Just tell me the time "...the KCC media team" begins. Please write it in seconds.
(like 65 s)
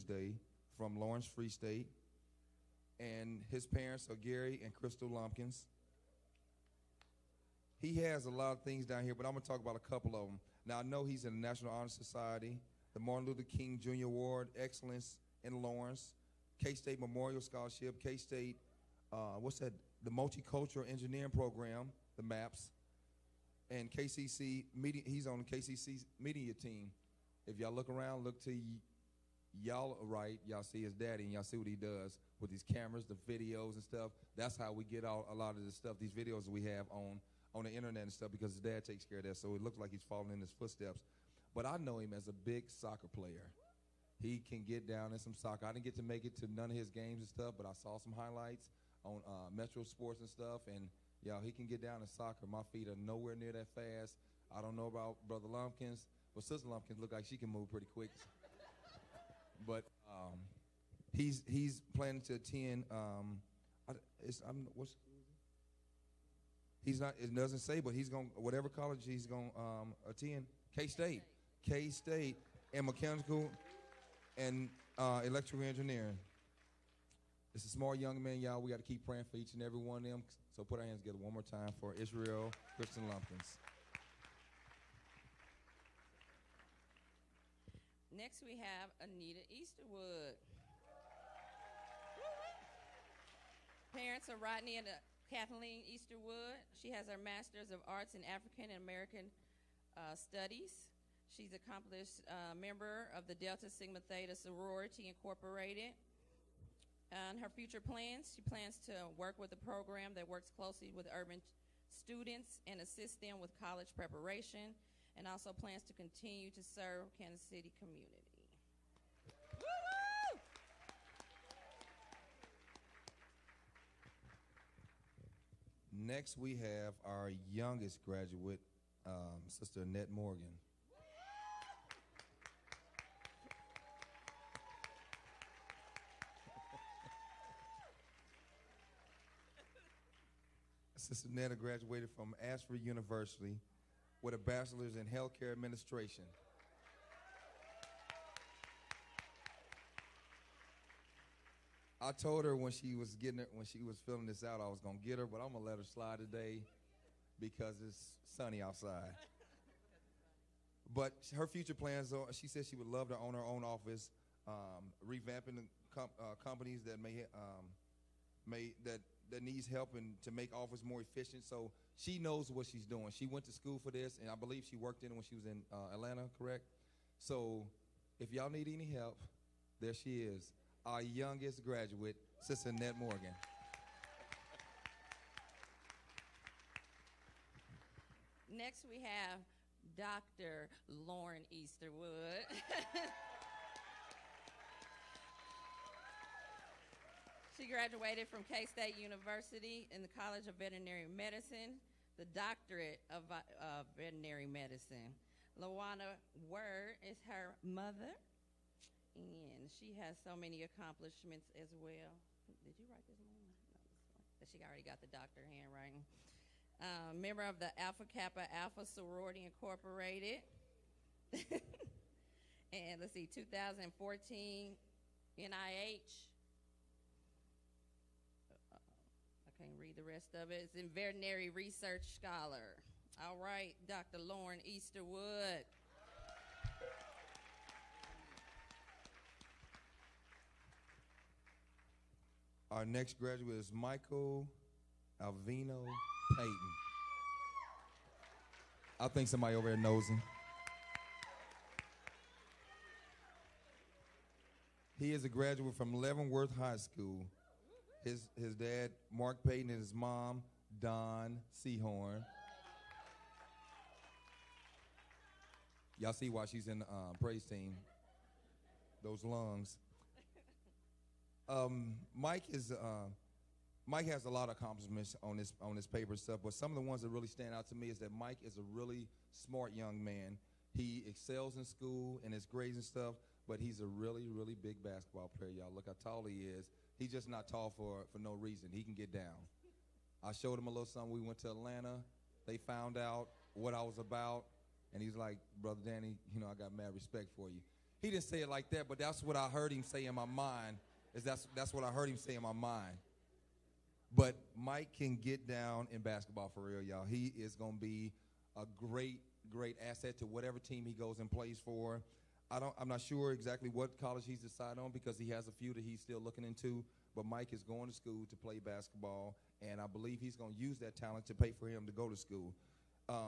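25 s.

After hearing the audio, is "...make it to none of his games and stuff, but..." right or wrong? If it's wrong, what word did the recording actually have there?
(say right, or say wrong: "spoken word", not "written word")
right.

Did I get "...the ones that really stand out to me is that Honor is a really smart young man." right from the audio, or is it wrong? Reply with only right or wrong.
wrong.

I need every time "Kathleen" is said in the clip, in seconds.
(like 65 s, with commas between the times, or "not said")
95 s.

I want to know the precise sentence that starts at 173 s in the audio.
She went to school for this, and I believe she worked in it when she was in uh, Atlanta, correct?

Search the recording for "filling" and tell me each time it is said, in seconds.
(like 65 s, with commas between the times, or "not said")
154 s.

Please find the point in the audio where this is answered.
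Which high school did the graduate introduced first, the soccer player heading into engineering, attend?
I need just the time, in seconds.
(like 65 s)
0 s.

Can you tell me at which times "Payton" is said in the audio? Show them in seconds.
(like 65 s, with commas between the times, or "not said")
246 s, 259 s.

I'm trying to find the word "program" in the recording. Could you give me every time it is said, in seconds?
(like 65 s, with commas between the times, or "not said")
21 s, 109 s.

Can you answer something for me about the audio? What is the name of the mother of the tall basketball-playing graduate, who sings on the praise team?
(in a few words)
Dawn Seahorn.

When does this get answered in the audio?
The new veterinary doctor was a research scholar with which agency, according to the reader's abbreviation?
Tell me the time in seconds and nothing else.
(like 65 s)
225 s.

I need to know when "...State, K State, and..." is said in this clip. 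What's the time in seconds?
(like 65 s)
70 s.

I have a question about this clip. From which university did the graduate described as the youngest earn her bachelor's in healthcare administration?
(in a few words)
Ashford University.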